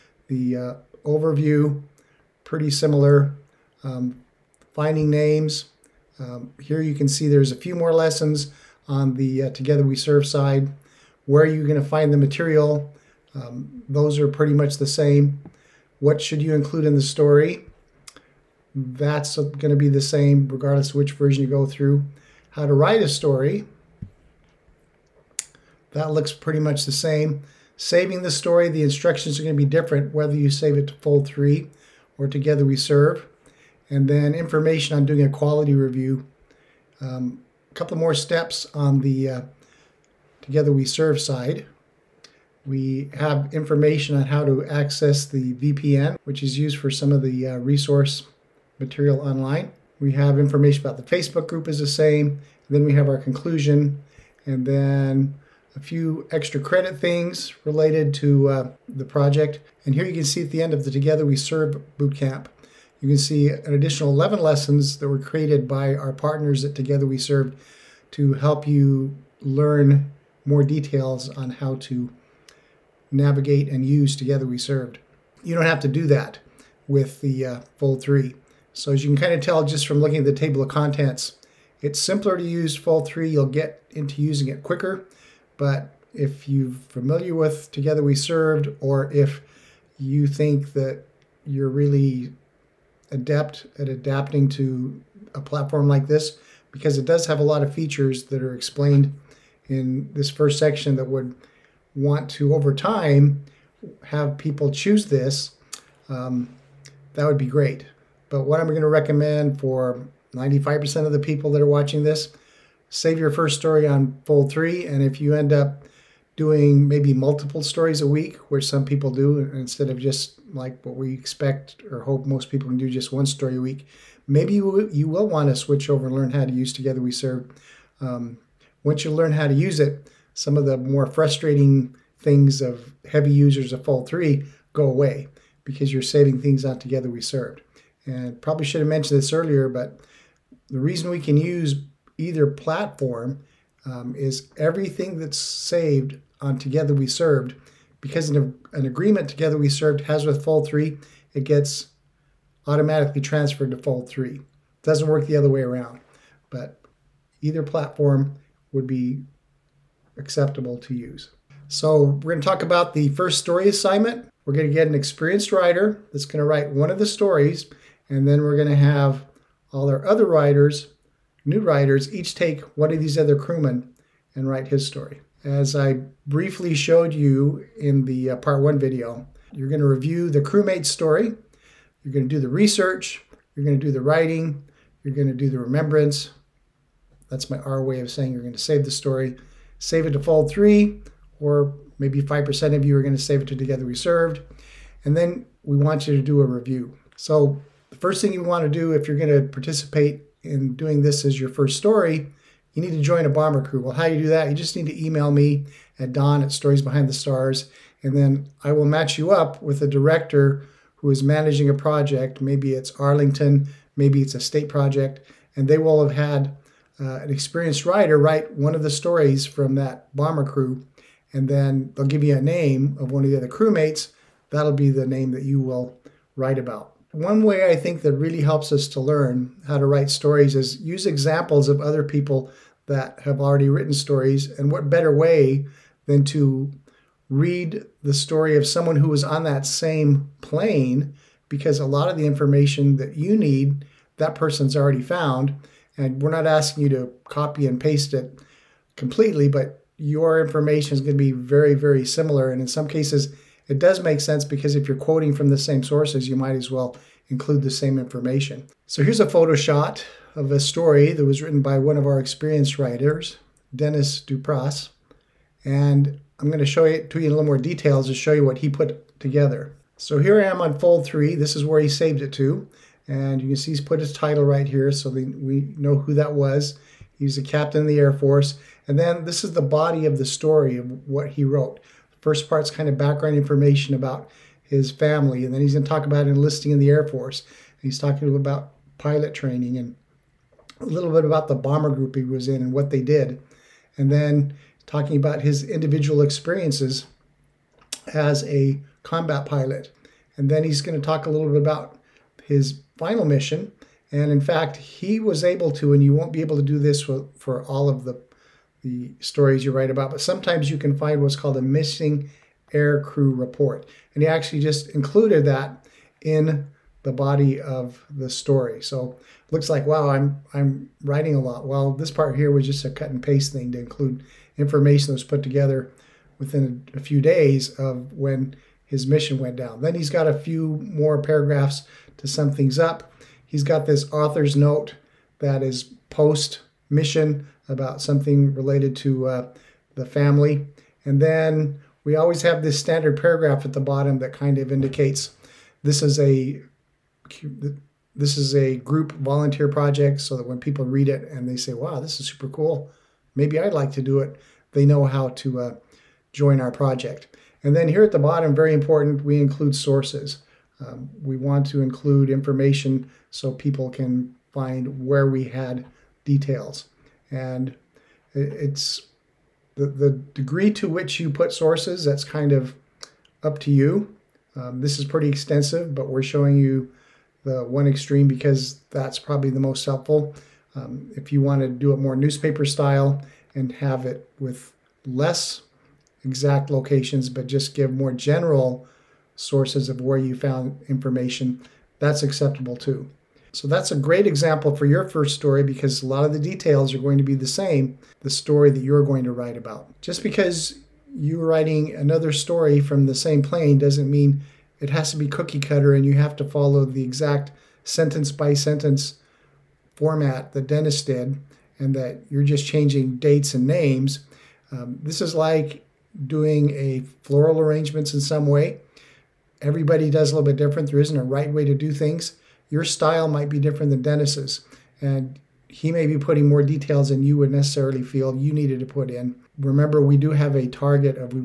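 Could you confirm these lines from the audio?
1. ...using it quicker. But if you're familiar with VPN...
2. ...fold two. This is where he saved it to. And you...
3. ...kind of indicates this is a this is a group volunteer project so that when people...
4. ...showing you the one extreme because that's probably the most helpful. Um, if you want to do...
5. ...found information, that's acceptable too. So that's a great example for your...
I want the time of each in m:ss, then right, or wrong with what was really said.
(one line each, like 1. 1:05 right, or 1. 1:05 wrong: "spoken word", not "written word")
1. 1:24 wrong: "Together", not "VPN"
2. 4:30 wrong: "three", not "two"
3. 5:44 right
4. 6:16 right
5. 6:30 right.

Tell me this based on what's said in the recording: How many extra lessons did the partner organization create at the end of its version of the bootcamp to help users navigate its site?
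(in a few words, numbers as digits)
11.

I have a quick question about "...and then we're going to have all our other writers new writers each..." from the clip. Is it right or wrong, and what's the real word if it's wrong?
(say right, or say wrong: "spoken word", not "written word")
right.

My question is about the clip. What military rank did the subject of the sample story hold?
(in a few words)
Captain.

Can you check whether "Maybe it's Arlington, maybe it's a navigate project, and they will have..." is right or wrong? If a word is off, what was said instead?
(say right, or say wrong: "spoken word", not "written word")
wrong: "state", not "navigate".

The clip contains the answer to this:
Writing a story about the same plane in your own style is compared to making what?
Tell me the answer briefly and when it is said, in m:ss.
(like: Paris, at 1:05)
Floral arrangements, at 6:57.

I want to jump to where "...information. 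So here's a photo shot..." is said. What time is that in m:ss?
4:17.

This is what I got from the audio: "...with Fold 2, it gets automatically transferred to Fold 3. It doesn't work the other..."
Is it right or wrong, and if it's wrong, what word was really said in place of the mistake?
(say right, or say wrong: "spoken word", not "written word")
wrong: "3", not "2".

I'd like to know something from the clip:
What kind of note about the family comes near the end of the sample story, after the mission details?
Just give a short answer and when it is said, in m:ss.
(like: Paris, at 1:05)
Author's note, at 5:34.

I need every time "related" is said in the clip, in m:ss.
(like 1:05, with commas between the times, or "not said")
0:57, 5:38.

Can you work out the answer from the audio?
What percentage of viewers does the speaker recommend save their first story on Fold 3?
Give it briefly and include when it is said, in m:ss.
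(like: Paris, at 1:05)
95%, at 1:50.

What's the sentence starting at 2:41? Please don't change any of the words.
So we're going to talk about the first story assignment.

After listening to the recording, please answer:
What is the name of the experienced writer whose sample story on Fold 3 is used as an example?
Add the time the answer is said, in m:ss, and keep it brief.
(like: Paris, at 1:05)
Dennis Dupras, at 4:23.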